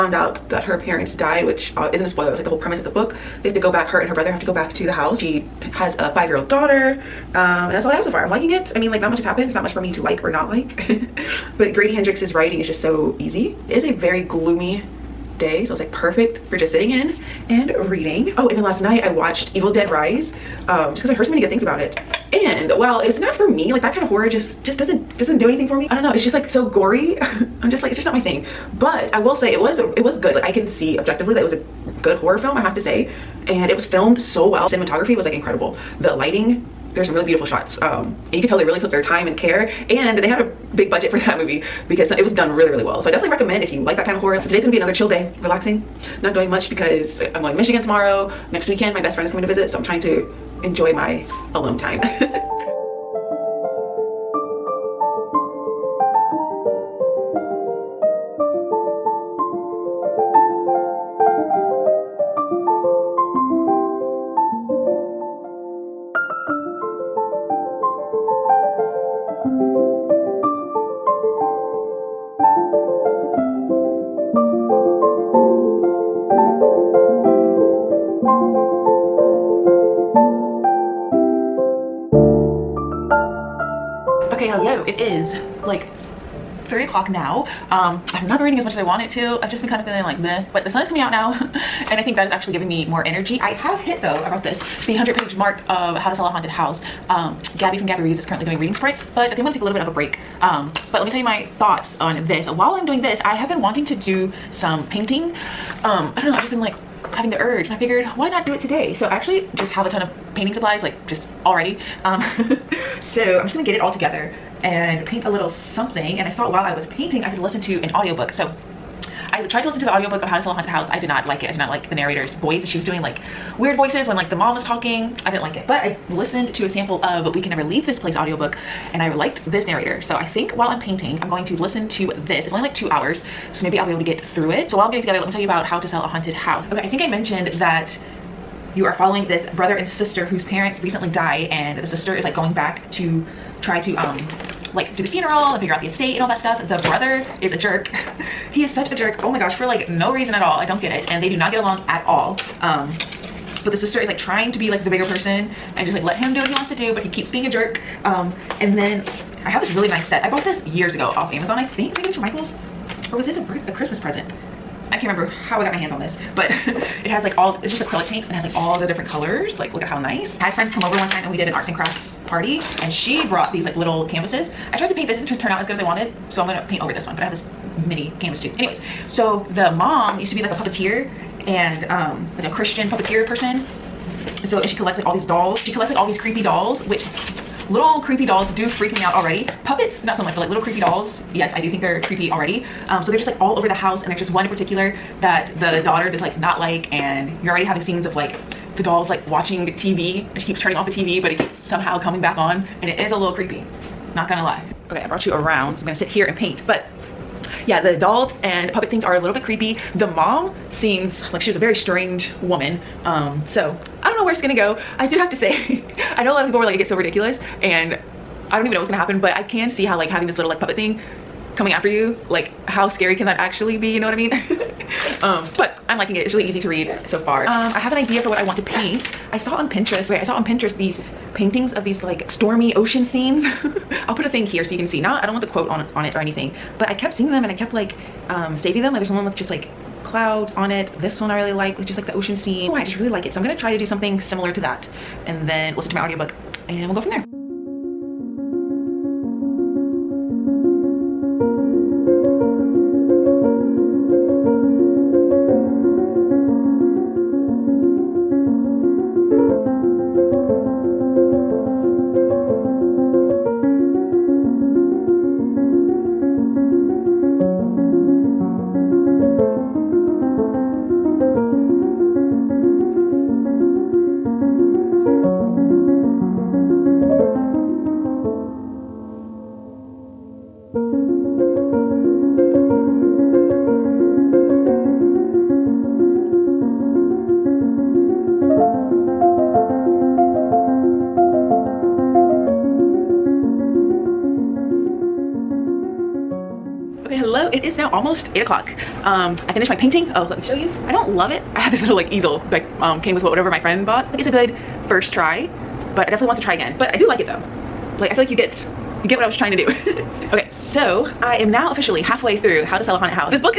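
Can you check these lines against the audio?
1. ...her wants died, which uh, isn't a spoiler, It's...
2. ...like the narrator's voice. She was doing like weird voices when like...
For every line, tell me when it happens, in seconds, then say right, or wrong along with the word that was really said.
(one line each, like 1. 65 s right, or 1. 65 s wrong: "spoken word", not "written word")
1. 0 s wrong: "parents", not "wants"
2. 121 s right.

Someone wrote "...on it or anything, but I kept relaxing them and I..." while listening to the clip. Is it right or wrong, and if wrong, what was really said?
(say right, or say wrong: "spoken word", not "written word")
wrong: "seeing", not "relaxing".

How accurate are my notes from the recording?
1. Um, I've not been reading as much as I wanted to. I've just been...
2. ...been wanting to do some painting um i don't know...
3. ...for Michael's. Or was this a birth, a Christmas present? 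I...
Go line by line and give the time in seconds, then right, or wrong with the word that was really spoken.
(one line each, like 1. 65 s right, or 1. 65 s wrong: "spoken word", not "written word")
1. 87 s right
2. 103 s right
3. 162 s right.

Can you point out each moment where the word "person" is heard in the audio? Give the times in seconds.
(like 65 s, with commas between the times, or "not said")
155 s, 183 s.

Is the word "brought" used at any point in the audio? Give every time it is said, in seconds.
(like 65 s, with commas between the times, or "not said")
94 s, 173 s, 205 s.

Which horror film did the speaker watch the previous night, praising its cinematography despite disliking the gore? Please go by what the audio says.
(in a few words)
Evil Dead Rise.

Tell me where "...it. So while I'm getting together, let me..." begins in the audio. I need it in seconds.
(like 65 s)
134 s.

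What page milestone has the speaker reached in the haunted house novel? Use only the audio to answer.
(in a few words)
100.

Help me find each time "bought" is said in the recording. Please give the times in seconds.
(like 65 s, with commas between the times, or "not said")
160 s, 303 s.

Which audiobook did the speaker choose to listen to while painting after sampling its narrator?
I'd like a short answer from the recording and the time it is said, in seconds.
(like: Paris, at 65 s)
We Can Never Leave This Place, at 127 s.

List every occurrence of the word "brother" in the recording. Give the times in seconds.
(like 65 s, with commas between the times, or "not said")
4 s, 139 s, 146 s.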